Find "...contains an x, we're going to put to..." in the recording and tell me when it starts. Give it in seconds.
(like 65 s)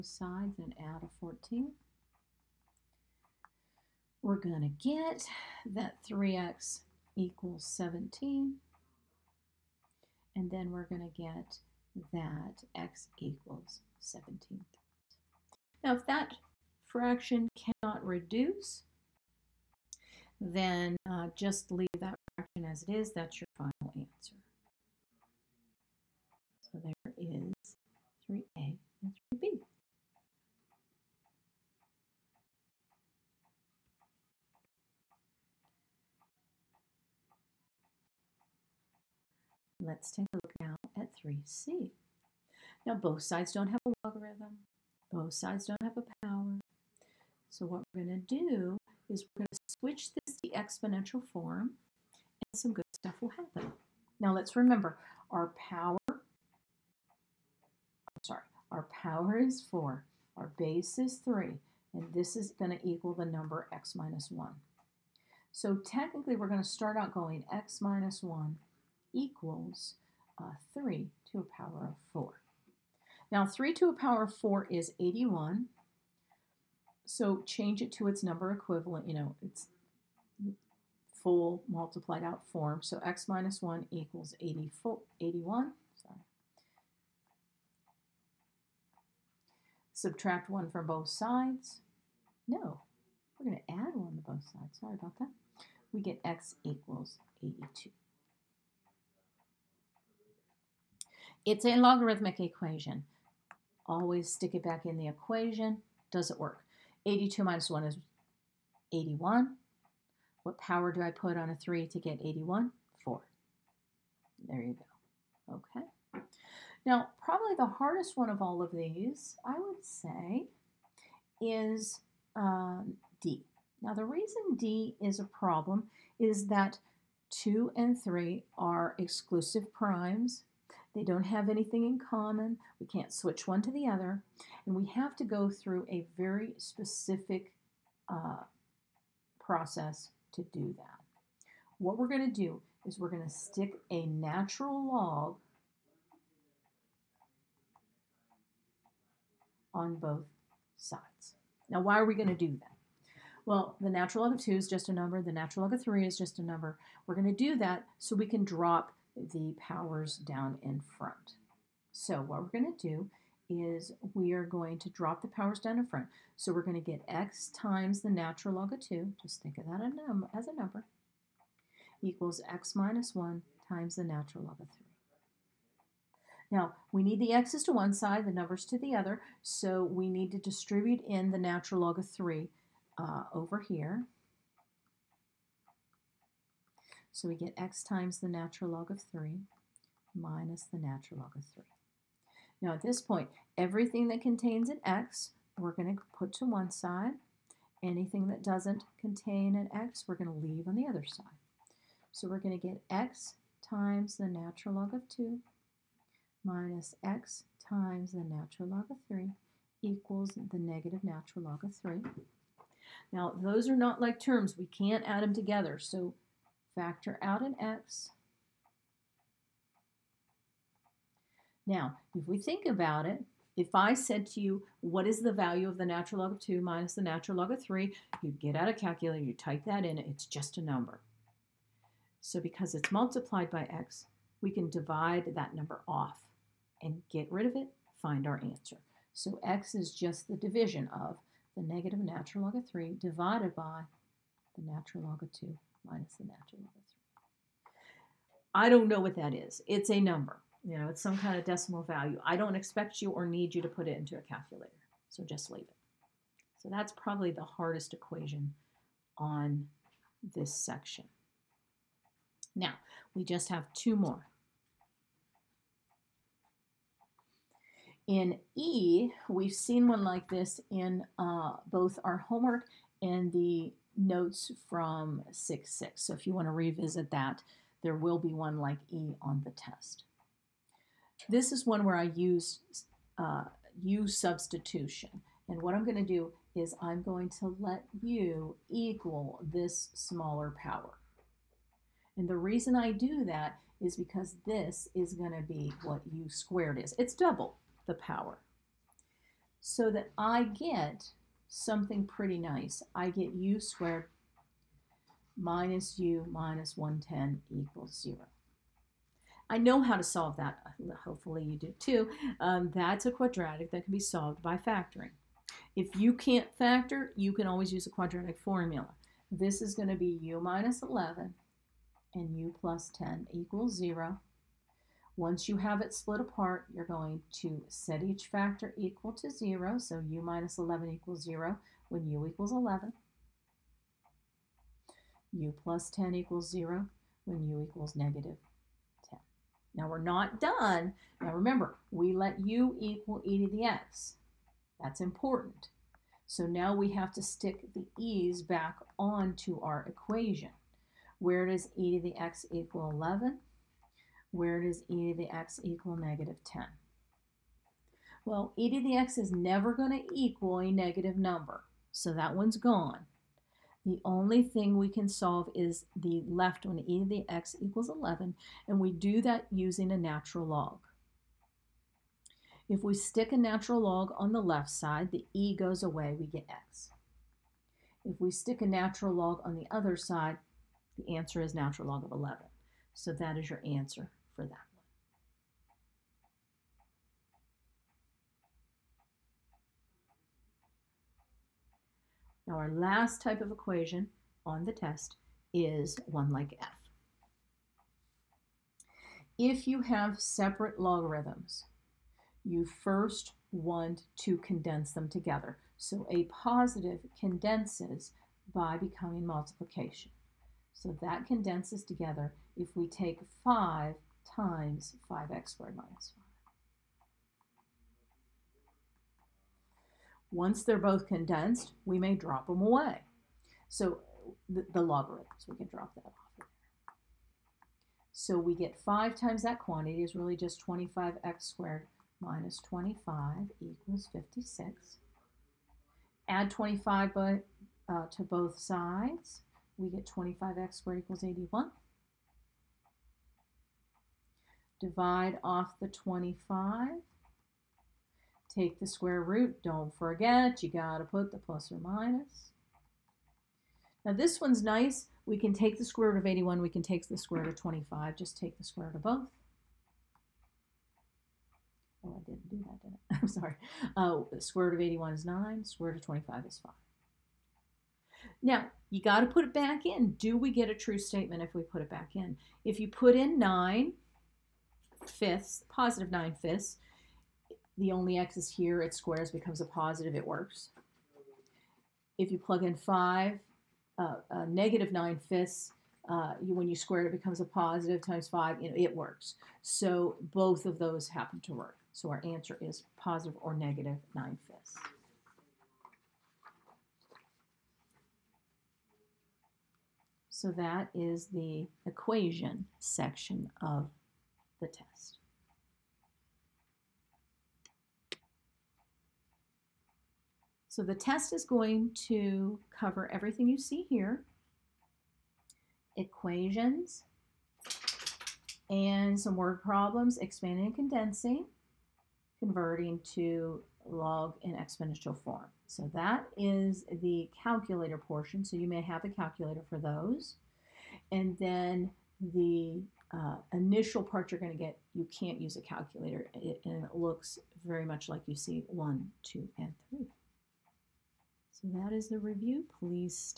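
194 s.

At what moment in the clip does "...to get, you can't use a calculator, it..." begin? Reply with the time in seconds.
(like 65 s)
534 s.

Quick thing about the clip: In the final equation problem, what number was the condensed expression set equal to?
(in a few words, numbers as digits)
56.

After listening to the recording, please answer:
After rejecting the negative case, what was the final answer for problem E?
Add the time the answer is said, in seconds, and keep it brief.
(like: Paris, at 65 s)
natural log of 11, at 381 s.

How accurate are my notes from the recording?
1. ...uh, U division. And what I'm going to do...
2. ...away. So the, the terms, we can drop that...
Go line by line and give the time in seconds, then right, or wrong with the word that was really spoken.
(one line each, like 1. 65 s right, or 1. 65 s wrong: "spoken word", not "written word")
1. 283 s wrong: "substitution", not "division"
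2. 422 s wrong: "logarithms", not "terms".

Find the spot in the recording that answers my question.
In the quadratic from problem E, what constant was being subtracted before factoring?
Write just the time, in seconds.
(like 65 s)
306 s.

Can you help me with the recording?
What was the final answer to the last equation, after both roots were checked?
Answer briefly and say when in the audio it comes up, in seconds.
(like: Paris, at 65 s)
positive or negative 9/5, at 492 s.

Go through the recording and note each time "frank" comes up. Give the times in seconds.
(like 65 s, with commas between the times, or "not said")
not said.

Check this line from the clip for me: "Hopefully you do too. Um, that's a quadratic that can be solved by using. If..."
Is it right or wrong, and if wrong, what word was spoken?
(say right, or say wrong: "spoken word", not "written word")
wrong: "factoring", not "using".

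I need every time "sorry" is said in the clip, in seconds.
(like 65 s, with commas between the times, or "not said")
58 s, 94 s, 463 s.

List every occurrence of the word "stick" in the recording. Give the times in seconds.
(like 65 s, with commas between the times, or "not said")
104 s, 143 s, 347 s, 372 s, 378 s.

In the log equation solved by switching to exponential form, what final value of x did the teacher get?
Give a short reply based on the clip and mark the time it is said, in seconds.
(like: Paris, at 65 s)
82, at 96 s.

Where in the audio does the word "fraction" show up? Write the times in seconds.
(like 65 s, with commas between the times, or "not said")
16 s, 22 s.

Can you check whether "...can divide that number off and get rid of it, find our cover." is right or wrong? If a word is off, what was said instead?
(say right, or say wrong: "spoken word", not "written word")
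wrong: "answer", not "cover".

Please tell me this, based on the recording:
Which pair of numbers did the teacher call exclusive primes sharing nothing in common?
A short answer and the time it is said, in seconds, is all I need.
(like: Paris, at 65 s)
2 and 3, at 127 s.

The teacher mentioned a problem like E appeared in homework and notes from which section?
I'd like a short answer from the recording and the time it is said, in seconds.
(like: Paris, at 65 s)
6-6, at 275 s.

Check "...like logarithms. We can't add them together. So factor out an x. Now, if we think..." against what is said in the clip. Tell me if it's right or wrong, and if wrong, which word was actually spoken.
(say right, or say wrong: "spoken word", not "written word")
wrong: "terms", not "logarithms".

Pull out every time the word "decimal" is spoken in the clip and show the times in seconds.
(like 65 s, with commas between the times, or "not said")
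251 s.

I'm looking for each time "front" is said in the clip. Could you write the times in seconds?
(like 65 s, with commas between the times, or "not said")
160 s, 165 s.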